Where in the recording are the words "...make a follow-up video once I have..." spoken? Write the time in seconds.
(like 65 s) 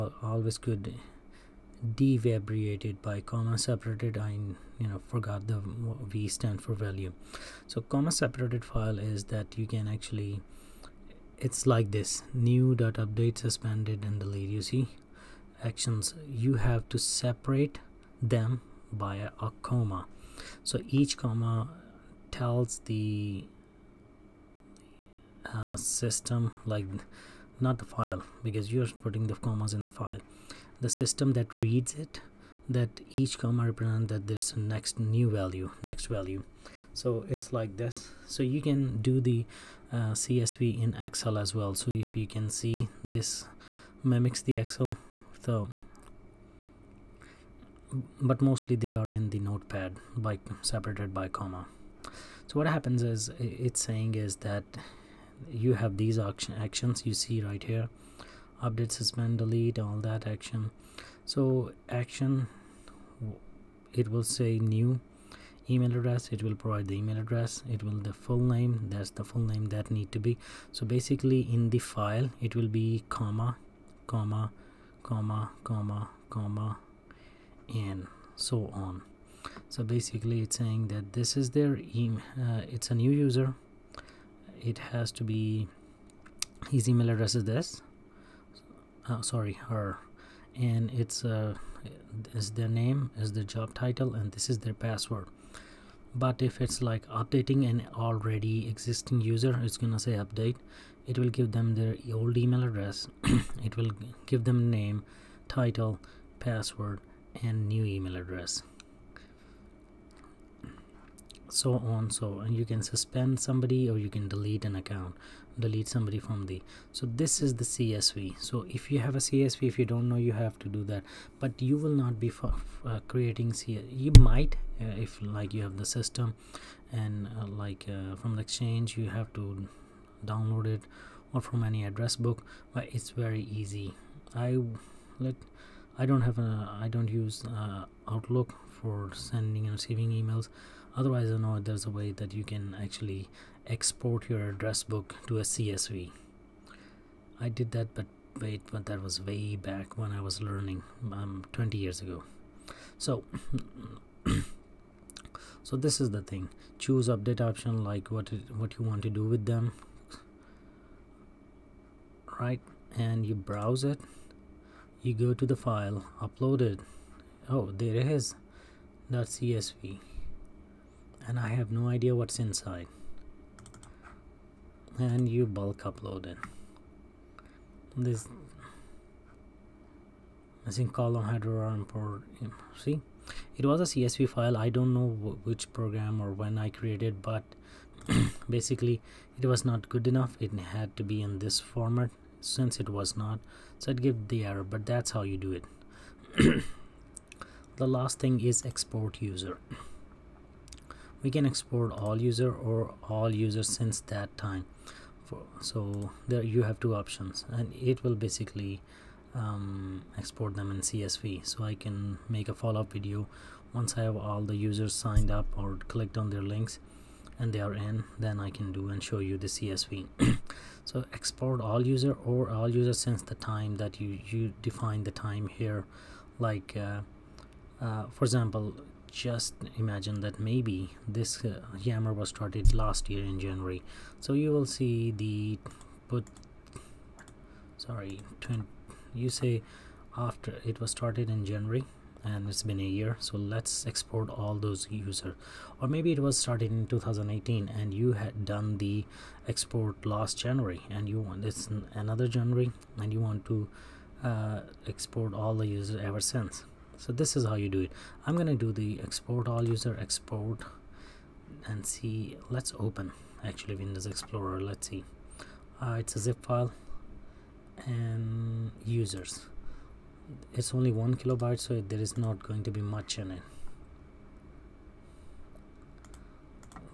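212 s.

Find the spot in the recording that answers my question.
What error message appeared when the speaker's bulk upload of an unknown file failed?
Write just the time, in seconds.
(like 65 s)
180 s.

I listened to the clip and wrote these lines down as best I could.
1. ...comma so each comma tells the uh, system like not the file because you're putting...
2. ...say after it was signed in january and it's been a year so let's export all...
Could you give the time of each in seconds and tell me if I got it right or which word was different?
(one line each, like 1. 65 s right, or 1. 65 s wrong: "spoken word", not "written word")
1. 19 s right
2. 239 s wrong: "started", not "signed".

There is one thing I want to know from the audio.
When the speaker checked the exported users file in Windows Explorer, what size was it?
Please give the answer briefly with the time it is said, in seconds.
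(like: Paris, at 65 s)
1 kilobyte, at 271 s.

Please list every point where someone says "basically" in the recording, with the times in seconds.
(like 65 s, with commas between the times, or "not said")
70 s, 79 s, 188 s, 208 s.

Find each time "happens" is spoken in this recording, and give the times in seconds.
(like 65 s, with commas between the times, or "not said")
52 s.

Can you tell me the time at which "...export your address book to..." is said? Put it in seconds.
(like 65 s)
143 s.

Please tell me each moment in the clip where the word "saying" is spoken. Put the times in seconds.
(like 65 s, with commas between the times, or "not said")
53 s, 80 s.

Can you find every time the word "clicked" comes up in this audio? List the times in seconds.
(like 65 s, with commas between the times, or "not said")
215 s.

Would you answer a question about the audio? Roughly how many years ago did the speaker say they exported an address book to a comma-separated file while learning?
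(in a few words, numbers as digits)
20 years.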